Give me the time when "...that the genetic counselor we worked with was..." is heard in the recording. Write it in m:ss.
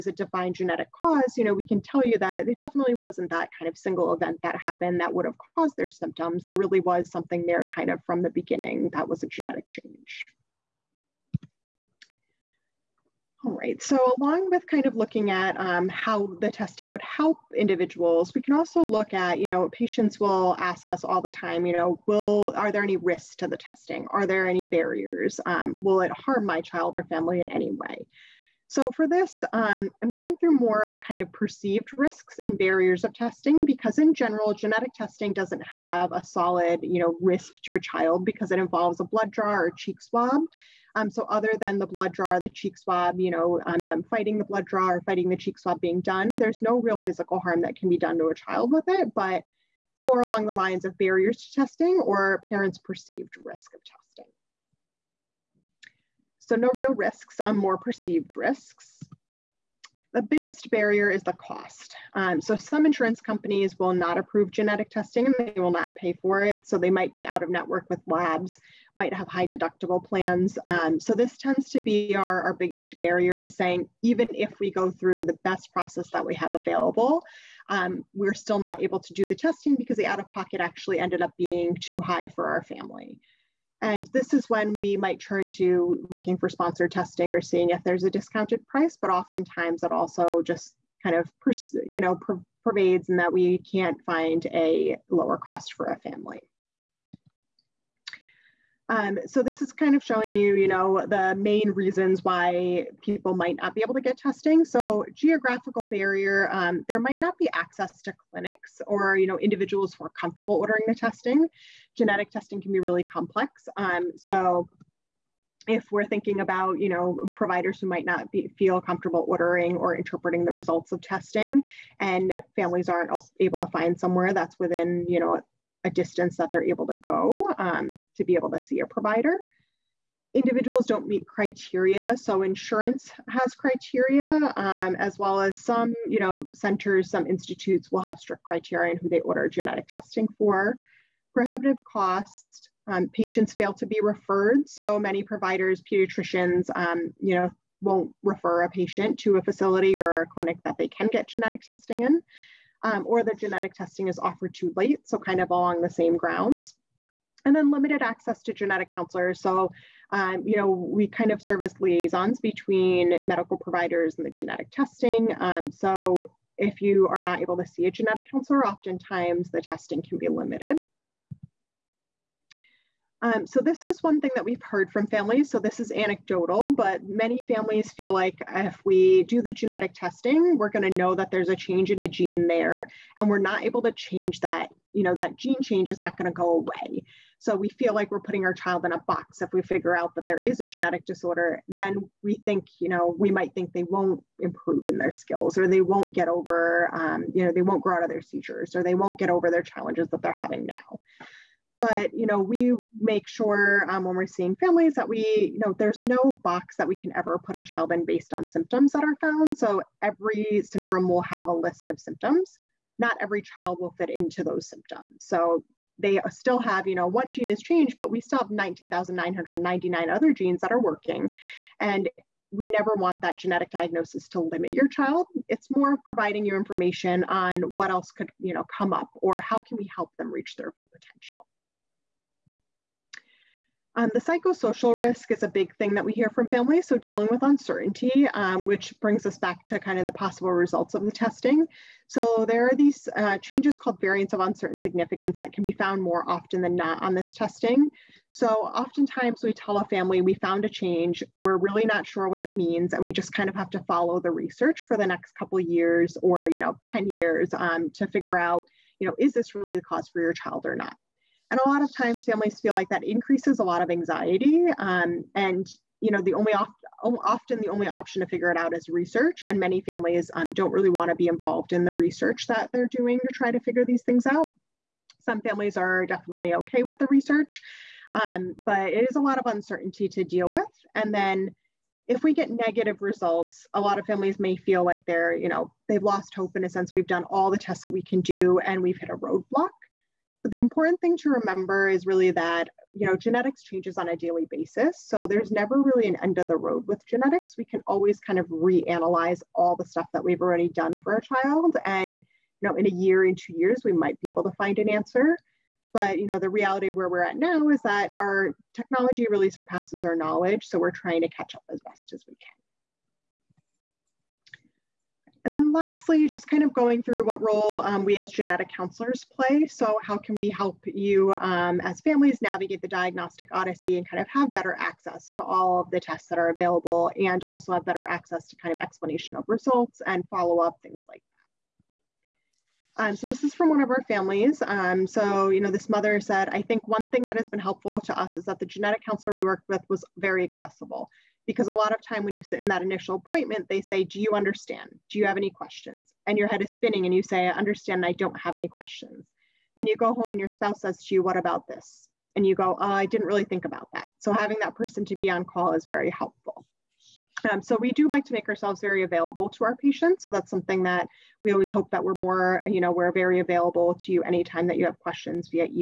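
5:38.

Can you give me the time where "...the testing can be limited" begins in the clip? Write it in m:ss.
2:49.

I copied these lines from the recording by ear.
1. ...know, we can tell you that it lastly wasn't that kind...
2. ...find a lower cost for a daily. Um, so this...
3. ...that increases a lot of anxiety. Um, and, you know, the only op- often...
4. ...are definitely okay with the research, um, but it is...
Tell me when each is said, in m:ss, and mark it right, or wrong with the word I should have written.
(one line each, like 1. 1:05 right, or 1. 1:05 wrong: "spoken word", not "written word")
1. 0:01 wrong: "definitely", not "lastly"
2. 1:34 wrong: "family", not "daily"
3. 4:22 right
4. 4:35 right.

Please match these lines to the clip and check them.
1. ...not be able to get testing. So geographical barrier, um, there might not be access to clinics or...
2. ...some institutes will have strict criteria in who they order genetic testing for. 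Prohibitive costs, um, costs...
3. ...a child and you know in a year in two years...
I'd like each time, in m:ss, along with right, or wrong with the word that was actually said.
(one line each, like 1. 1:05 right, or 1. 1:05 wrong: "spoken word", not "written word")
1. 1:43 right
2. 2:17 wrong: "patients", not "costs"
3. 5:01 right.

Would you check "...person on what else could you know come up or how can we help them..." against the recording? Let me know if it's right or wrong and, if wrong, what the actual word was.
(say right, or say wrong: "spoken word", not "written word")
wrong: "information", not "person".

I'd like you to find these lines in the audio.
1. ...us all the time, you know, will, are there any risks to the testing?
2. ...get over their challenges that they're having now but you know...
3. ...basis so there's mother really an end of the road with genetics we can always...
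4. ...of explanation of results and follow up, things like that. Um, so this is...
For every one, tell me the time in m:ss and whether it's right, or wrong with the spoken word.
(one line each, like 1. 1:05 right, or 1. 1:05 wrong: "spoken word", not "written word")
1. 0:20 right
2. 3:19 right
3. 4:54 wrong: "never", not "mother"
4. 5:28 right.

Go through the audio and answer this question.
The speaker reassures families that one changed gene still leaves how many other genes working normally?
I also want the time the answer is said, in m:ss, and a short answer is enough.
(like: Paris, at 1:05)
19,999, at 3:38.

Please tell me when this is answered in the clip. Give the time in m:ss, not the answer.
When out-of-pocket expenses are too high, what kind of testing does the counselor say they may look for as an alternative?
1:26.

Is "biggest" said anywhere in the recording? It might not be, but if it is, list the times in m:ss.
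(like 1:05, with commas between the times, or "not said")
1:00, 1:12.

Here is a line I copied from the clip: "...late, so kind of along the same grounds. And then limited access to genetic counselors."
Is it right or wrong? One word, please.
right.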